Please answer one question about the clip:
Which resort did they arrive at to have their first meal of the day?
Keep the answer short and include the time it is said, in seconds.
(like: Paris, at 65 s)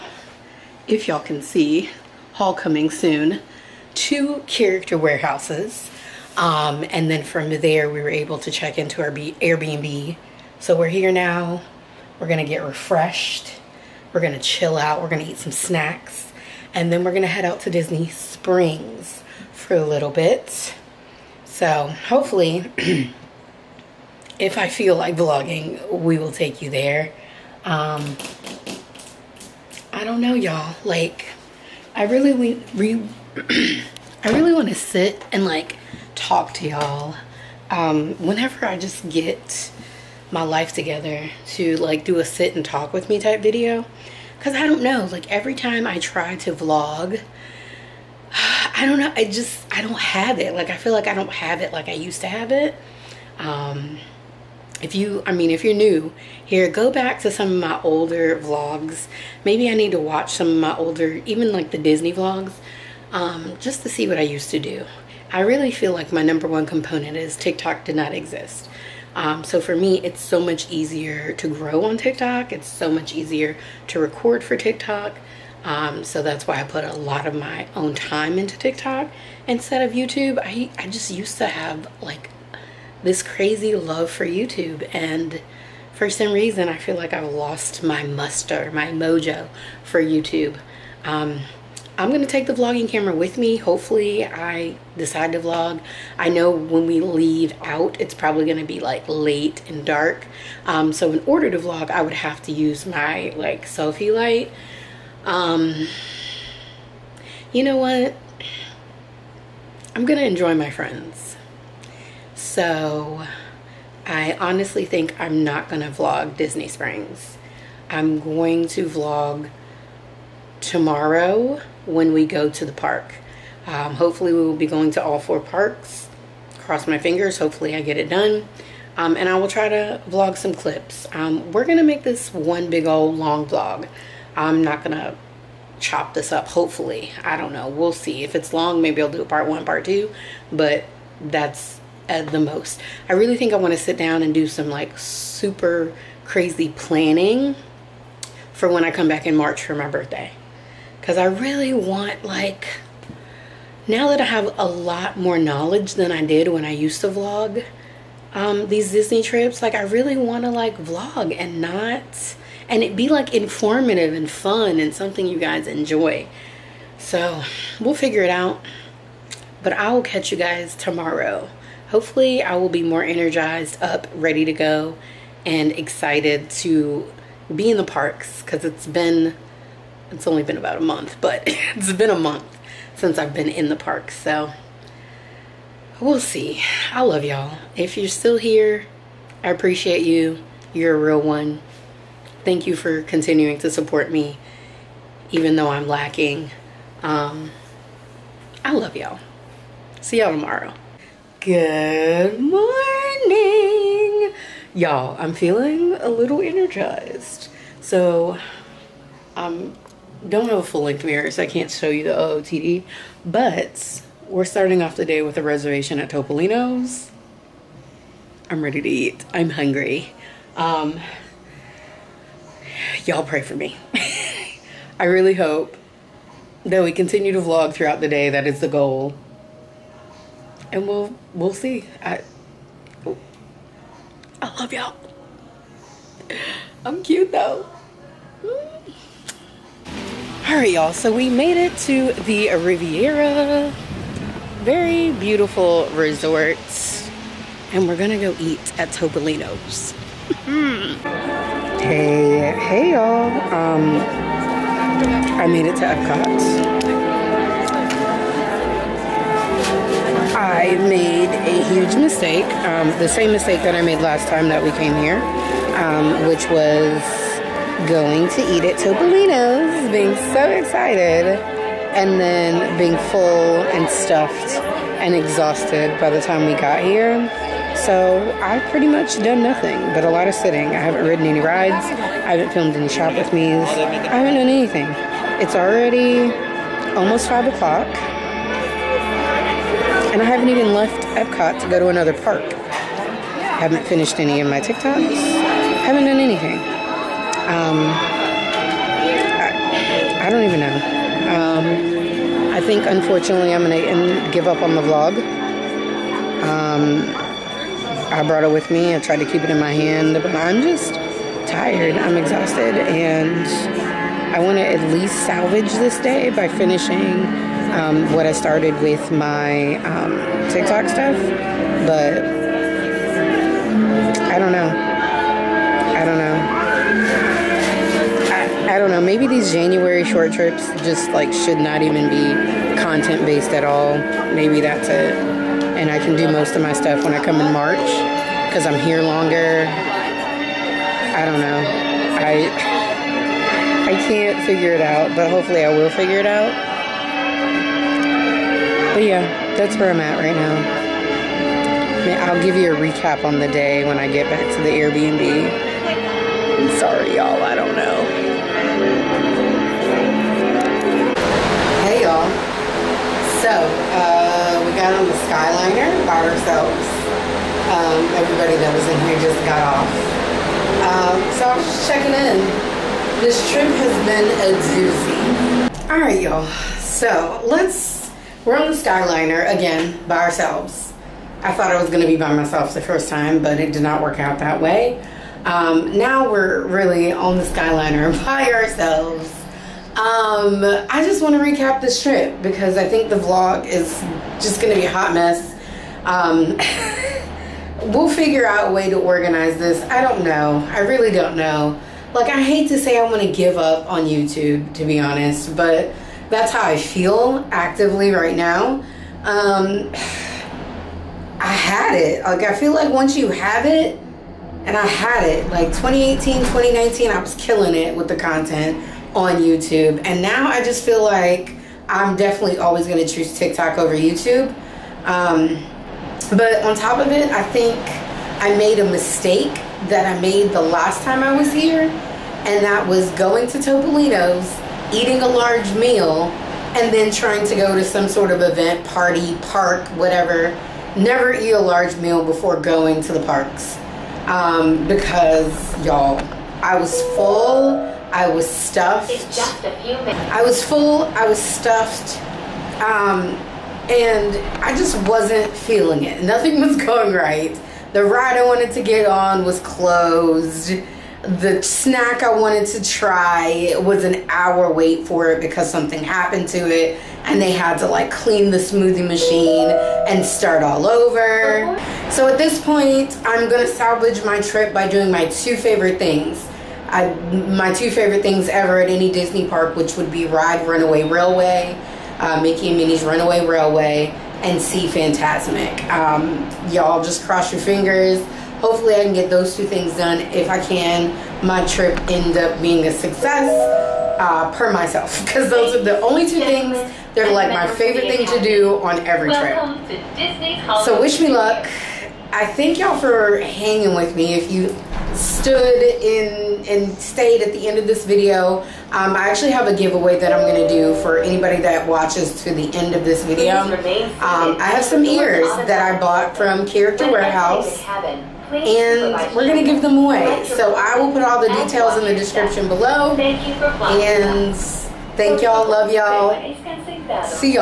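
Riviera, at 242 s.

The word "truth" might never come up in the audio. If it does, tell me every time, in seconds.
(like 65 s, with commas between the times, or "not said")
not said.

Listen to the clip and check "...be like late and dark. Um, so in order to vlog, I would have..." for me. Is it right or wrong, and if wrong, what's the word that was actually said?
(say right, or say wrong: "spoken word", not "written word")
right.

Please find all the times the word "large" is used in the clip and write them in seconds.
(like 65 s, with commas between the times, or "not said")
435 s, 441 s.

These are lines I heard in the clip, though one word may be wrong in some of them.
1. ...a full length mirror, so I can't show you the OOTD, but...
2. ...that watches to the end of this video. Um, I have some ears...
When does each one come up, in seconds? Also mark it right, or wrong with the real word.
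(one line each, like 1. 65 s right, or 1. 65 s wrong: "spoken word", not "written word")
1. 210 s right
2. 511 s right.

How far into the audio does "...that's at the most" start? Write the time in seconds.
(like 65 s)
141 s.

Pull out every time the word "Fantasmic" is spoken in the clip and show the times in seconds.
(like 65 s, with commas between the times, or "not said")
484 s.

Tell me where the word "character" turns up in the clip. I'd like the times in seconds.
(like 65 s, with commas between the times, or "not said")
4 s, 516 s.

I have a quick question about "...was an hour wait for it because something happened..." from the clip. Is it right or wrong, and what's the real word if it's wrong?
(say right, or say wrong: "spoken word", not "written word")
right.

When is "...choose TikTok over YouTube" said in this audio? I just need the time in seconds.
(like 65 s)
423 s.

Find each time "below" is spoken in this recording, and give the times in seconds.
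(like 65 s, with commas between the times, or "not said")
522 s.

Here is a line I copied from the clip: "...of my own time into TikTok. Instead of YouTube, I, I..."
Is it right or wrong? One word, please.
right.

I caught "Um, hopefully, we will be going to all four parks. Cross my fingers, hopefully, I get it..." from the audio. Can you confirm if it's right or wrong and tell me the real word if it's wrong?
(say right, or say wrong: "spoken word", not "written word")
right.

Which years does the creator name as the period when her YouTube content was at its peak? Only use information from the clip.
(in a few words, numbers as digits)
2018, 2019.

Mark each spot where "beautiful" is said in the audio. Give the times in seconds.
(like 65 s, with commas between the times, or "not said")
245 s.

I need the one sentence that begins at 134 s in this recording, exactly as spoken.
I'm not going to chop this up, hopefully.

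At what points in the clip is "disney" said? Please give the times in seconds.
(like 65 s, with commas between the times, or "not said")
17 s, 61 s, 116 s, 158 s, 479 s.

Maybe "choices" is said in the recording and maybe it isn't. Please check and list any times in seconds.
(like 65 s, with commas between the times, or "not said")
not said.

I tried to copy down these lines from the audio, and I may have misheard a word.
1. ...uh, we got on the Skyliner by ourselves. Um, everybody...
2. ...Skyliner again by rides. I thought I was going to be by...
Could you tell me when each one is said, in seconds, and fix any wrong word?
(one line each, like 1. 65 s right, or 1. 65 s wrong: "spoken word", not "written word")
1. 363 s right
2. 378 s wrong: "ourselves", not "rides".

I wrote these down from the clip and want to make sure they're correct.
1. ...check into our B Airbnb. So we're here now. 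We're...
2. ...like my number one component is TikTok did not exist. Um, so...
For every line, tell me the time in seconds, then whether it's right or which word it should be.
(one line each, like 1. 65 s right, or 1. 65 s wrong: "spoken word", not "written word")
1. 8 s right
2. 65 s right.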